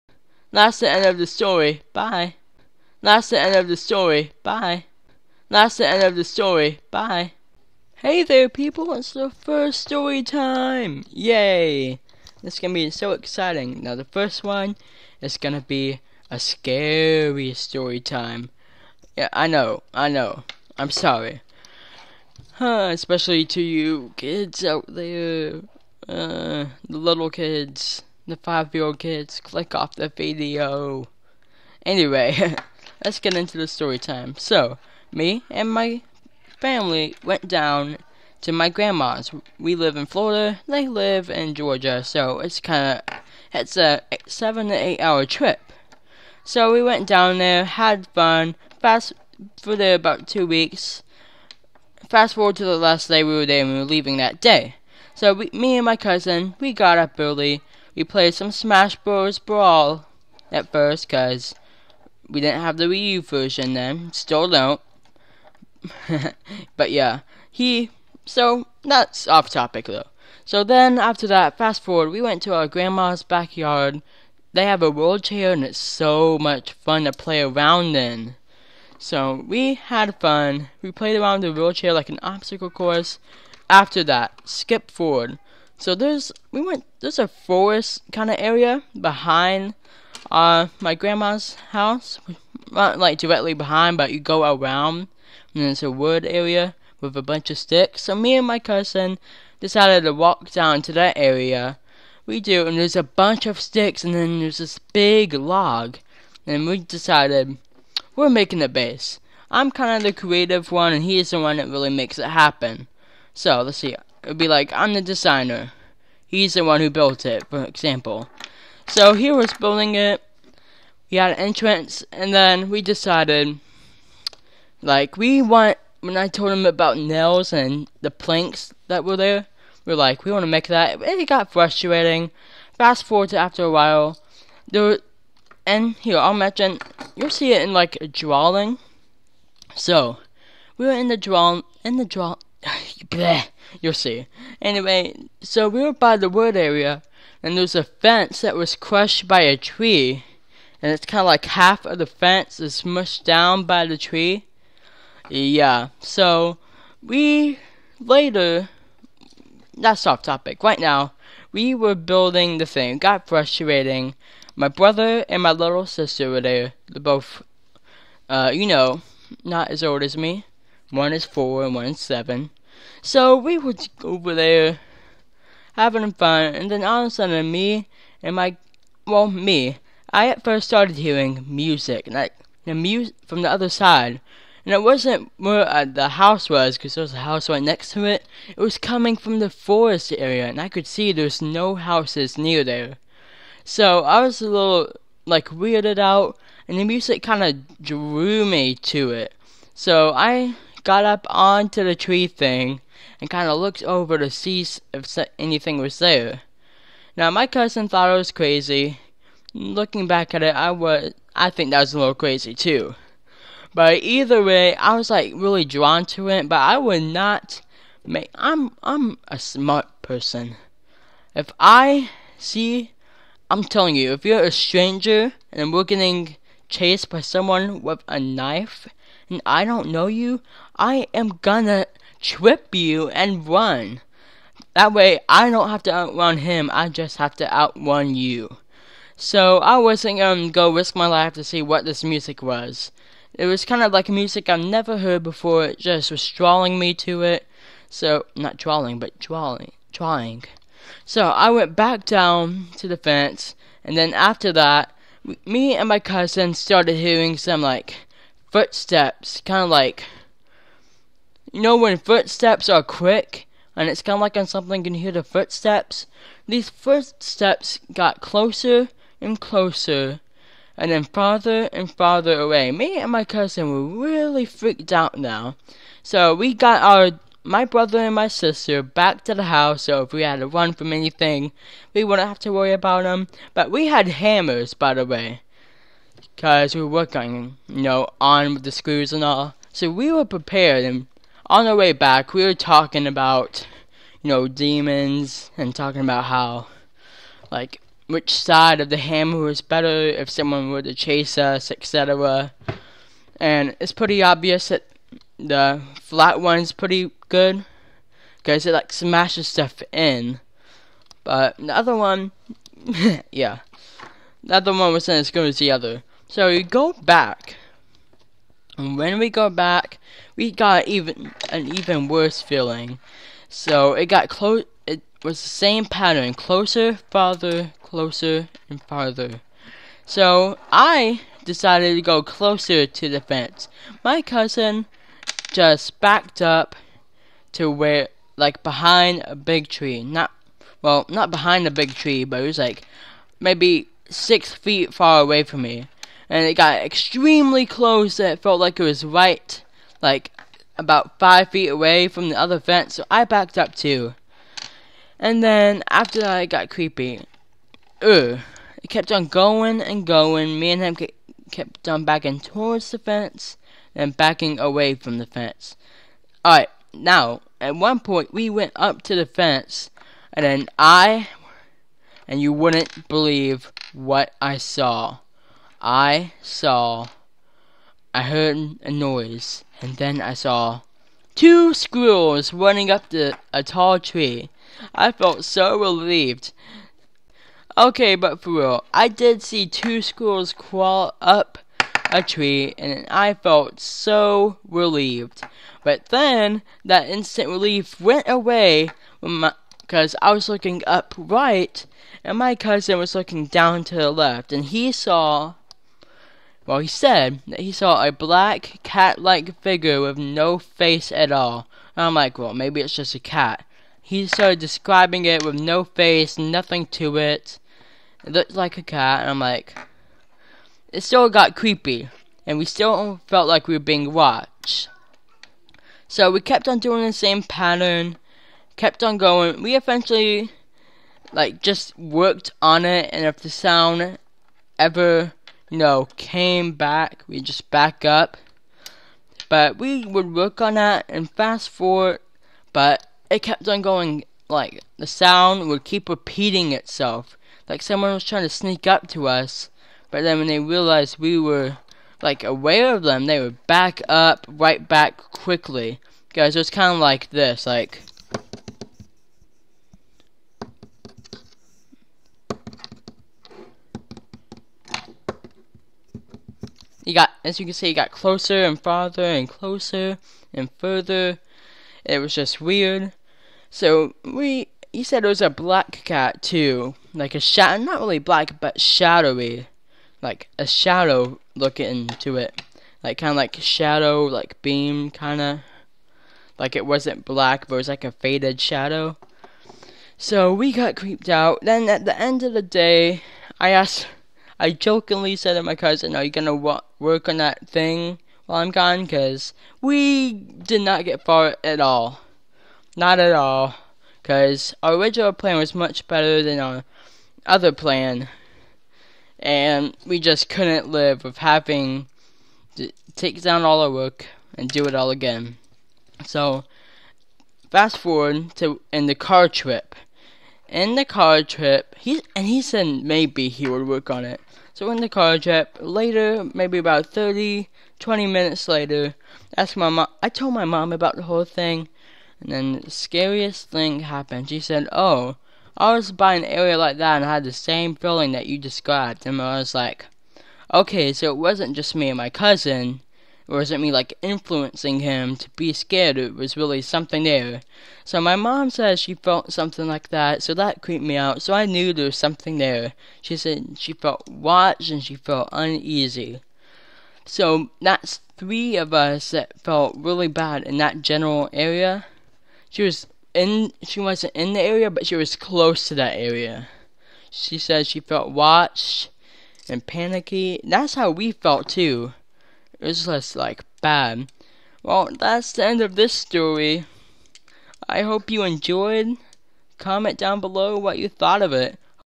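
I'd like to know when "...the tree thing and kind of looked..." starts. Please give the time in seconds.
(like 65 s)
201 s.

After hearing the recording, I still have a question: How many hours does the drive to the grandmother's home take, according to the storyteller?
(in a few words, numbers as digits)
7 to 8 hours.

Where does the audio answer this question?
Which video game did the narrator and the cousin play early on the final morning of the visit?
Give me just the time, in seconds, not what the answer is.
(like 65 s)
58 s.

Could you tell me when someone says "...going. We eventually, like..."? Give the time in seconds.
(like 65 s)
429 s.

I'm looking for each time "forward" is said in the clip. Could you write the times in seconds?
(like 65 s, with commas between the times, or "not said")
52 s, 71 s, 84 s, 133 s, 441 s, 517 s.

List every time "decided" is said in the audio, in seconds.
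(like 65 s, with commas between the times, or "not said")
99 s, 106 s, 122 s, 331 s.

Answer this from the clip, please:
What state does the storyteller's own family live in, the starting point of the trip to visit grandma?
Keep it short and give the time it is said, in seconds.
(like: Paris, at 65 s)
Florida, at 40 s.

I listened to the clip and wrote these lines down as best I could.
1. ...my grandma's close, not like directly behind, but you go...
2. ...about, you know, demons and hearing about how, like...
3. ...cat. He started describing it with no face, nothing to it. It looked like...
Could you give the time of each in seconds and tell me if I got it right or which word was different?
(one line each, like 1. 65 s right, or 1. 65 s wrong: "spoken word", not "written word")
1. 90 s wrong: "house", not "close"
2. 293 s wrong: "talking", not "hearing"
3. 413 s right.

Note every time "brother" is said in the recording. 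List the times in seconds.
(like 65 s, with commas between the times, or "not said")
164 s, 277 s.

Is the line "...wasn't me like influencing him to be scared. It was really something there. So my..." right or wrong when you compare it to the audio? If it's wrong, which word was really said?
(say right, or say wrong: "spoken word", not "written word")
right.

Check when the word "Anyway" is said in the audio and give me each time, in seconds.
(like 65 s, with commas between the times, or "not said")
31 s, 144 s.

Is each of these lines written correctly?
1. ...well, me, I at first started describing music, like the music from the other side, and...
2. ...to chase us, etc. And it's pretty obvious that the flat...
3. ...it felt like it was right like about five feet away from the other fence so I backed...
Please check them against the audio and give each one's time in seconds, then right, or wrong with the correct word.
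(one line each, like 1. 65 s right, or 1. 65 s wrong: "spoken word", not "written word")
1. 179 s wrong: "hearing", not "describing"
2. 300 s right
3. 348 s right.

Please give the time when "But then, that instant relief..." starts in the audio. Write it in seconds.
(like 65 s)
395 s.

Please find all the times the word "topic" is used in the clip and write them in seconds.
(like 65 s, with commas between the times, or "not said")
69 s, 160 s.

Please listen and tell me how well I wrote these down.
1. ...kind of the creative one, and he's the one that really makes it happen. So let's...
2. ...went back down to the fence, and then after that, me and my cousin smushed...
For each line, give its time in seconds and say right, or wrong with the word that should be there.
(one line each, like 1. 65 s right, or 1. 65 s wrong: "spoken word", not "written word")
1. 109 s right
2. 251 s wrong: "started", not "smushed".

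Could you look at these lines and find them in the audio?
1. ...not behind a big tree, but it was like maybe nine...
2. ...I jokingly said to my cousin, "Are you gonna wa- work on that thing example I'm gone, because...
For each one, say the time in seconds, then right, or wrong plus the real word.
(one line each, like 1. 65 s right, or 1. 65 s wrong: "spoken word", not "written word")
1. 341 s wrong: "six", not "nine"
2. 494 s wrong: "while", not "example".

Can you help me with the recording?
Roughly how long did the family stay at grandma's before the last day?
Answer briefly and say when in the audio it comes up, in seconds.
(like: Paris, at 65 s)
2 weeks, at 50 s.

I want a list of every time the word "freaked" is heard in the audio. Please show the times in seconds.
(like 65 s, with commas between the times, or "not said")
274 s.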